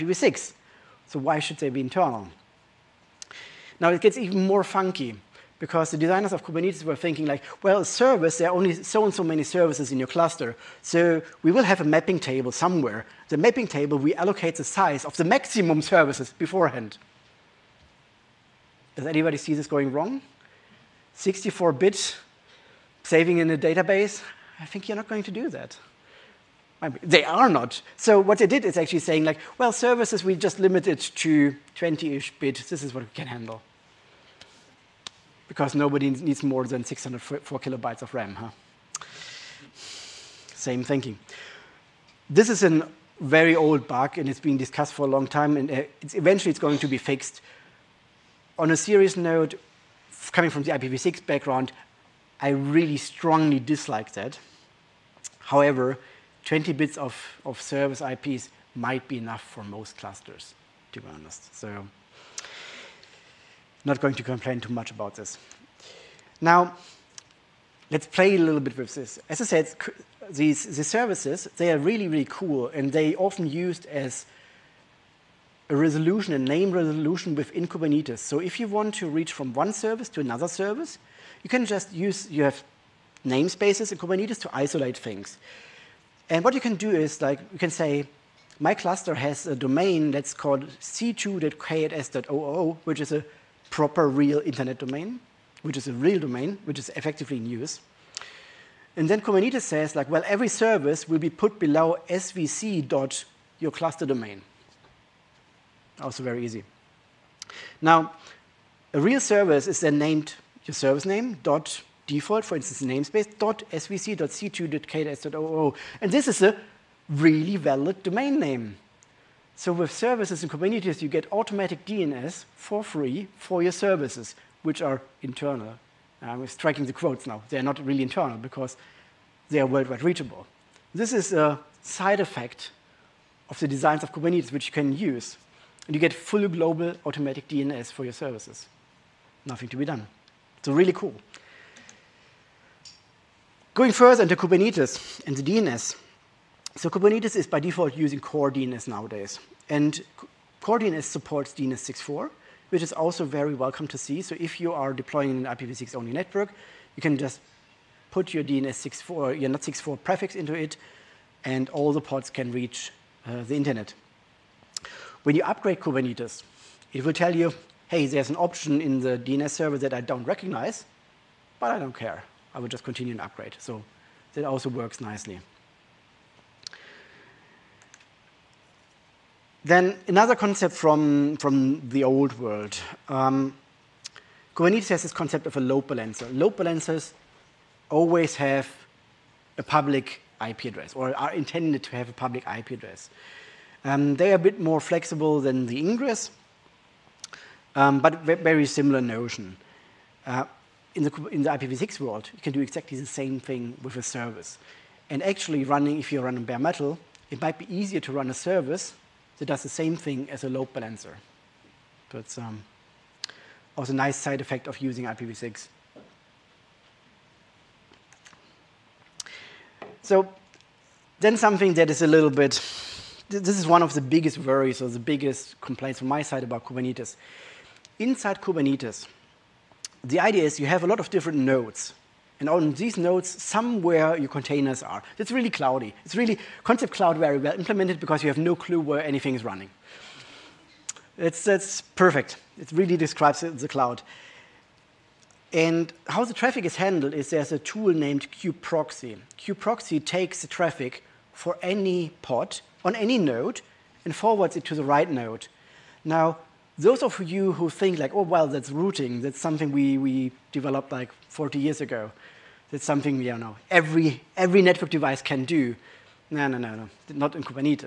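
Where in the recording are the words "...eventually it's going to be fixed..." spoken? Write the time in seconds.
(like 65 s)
46 s.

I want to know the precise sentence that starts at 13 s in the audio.
The mapping table, we allocate the size of the maximum services beforehand.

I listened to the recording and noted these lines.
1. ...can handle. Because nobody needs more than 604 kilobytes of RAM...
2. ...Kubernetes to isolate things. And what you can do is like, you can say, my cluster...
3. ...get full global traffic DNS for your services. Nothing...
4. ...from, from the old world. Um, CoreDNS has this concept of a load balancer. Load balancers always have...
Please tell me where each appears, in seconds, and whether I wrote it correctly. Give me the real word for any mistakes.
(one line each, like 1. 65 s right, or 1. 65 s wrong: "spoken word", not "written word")
1. 33 s right
2. 83 s right
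3. 135 s wrong: "automatic", not "traffic"
4. 180 s wrong: "Kubernetes", not "CoreDNS".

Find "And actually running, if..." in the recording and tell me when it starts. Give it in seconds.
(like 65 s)
205 s.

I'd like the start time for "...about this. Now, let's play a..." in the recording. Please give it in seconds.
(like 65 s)
64 s.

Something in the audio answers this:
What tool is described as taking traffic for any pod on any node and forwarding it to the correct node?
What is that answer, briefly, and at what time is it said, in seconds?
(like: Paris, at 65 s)
Kube proxy, at 248 s.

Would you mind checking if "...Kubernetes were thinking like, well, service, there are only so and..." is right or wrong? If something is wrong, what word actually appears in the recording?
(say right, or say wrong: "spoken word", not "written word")
right.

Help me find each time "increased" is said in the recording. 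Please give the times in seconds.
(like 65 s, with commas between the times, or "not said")
not said.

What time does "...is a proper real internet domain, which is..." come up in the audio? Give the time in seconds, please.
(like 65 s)
92 s.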